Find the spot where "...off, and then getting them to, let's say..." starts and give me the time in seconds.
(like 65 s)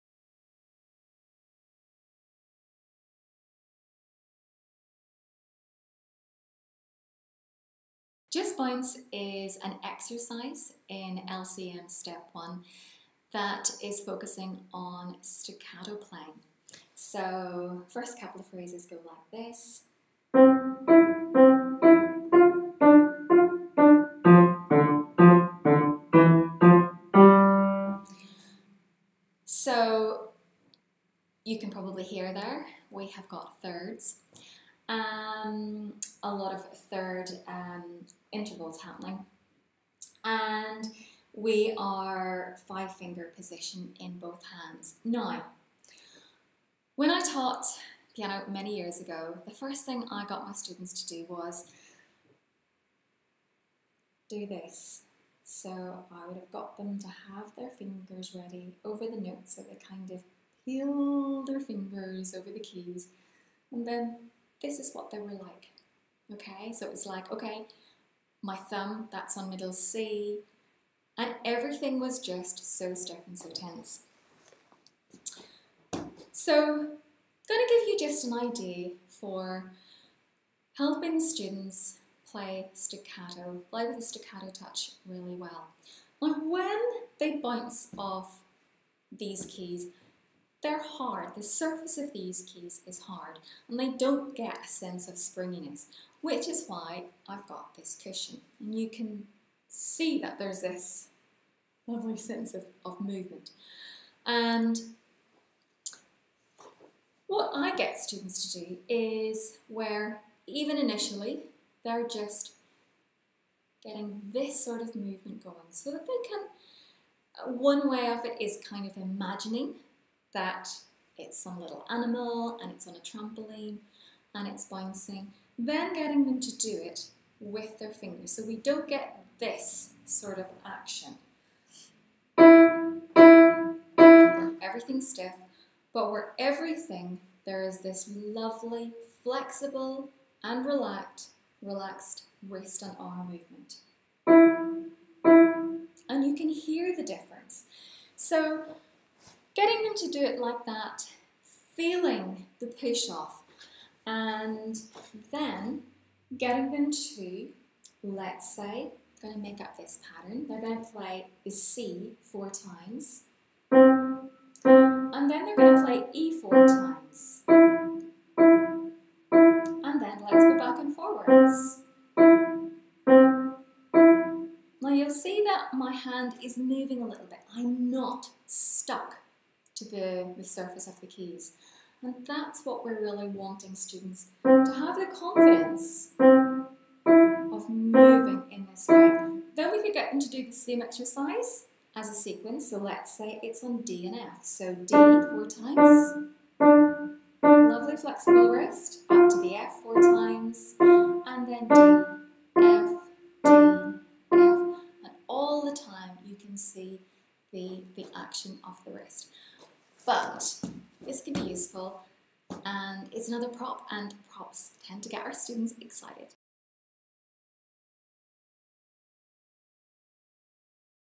153 s.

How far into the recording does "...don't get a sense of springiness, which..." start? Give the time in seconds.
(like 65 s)
93 s.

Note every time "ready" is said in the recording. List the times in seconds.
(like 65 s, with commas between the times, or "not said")
58 s.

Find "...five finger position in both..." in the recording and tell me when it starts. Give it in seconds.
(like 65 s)
42 s.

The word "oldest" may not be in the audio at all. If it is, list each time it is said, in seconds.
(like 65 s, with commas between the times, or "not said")
not said.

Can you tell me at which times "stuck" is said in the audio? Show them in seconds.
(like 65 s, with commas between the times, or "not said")
72 s, 178 s.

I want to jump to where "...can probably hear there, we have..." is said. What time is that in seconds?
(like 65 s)
31 s.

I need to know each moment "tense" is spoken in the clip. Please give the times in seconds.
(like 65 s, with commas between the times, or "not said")
73 s.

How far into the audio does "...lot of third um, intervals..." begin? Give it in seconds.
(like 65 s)
36 s.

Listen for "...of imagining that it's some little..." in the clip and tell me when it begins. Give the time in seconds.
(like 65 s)
118 s.